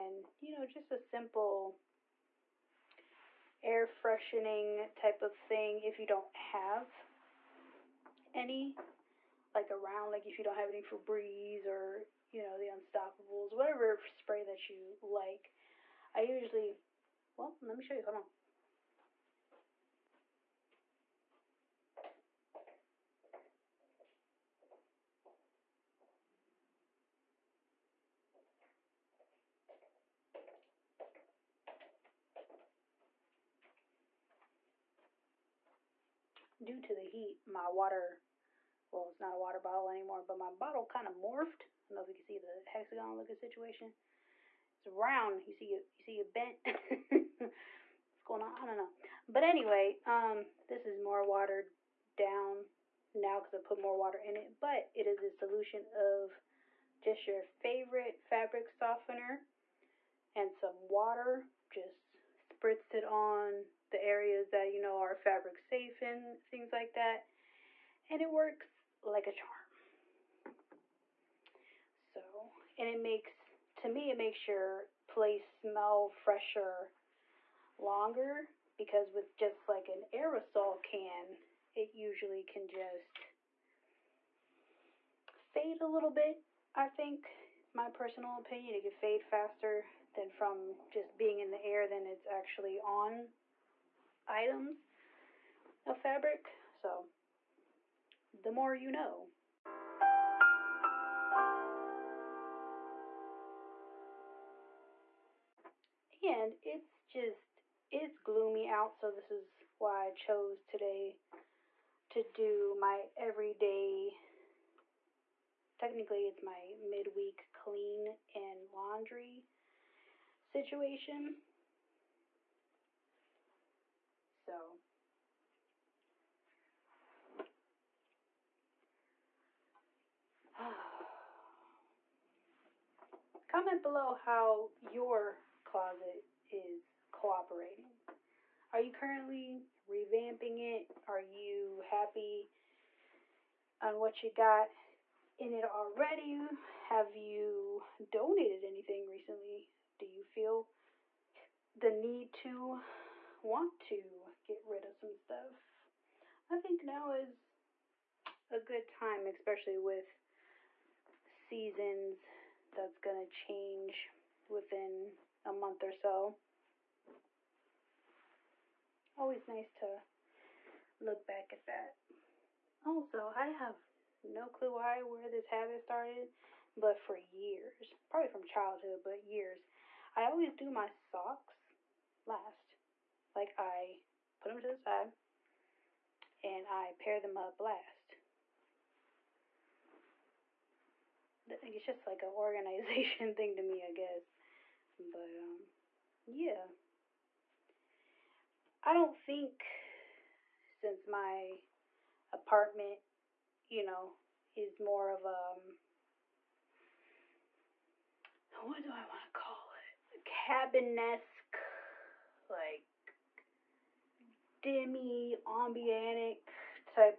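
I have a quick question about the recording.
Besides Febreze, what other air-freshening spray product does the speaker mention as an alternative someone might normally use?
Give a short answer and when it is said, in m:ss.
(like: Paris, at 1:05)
Unstopables, at 0:12.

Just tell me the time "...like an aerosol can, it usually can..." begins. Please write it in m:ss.
1:19.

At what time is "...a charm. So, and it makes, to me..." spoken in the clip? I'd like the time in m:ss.
1:09.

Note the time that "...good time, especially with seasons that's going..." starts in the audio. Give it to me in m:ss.
2:38.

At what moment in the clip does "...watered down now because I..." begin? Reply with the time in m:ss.
0:51.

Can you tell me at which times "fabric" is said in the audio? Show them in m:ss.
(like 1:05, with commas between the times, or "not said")
0:58, 1:05, 1:35.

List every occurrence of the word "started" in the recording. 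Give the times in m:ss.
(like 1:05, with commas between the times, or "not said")
2:55.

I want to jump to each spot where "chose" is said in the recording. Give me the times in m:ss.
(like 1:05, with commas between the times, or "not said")
1:50.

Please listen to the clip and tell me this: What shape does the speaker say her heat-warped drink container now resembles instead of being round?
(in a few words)
hexagon.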